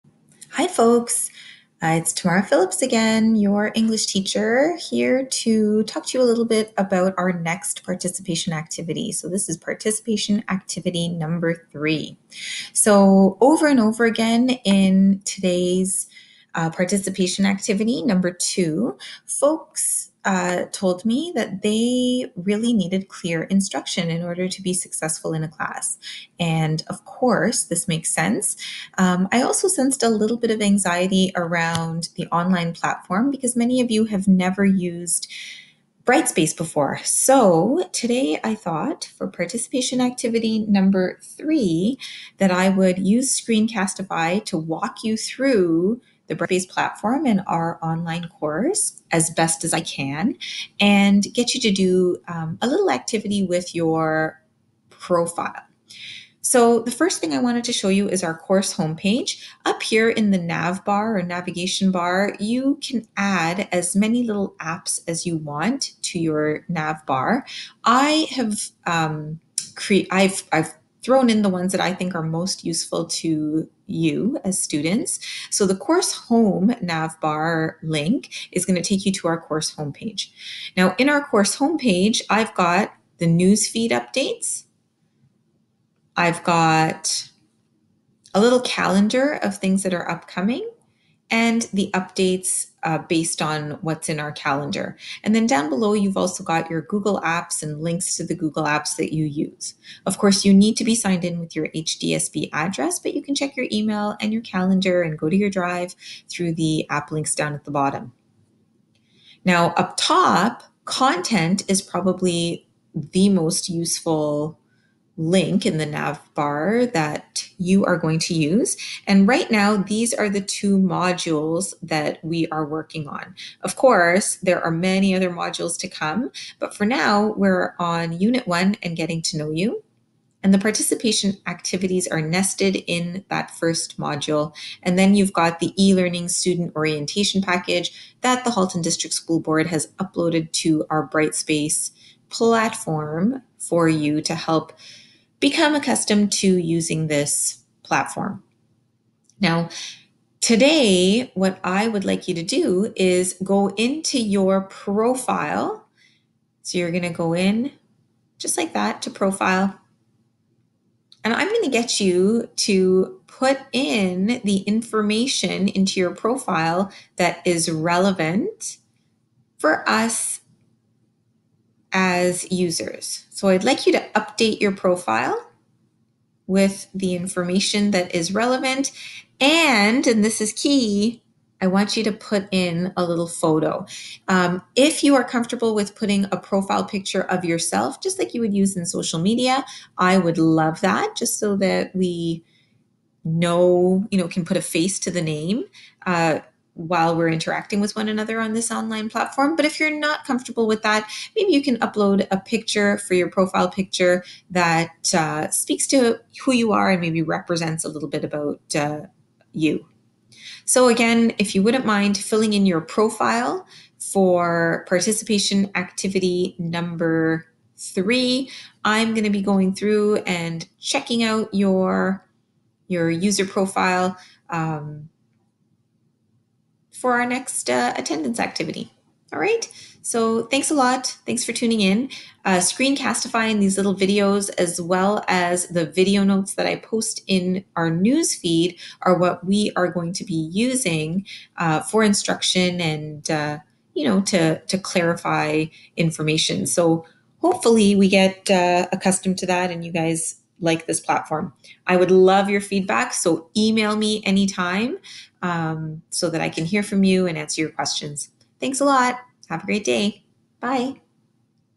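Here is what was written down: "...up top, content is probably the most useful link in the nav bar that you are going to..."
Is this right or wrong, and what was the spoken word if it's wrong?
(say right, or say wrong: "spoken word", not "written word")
right.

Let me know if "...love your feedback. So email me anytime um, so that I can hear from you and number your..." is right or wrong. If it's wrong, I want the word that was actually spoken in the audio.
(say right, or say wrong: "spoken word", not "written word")
wrong: "answer", not "number".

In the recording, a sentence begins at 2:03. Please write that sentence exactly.
Of course, there are many other modules to come, but for now, we're on Unit 1 and getting to know you.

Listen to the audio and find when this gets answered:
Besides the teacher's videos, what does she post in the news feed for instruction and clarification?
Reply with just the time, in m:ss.
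3:55.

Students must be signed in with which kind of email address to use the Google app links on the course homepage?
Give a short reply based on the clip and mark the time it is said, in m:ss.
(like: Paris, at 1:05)
HDSB address, at 1:41.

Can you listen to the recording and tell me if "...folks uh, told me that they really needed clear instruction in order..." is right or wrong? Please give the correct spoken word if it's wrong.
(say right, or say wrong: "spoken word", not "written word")
right.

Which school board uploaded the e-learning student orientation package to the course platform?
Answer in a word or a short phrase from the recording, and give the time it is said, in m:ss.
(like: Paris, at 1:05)
Halton District School Board, at 2:18.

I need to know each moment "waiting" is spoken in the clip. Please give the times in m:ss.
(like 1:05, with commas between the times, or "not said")
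not said.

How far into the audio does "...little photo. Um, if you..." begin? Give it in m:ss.
3:03.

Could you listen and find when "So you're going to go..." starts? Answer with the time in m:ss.
2:36.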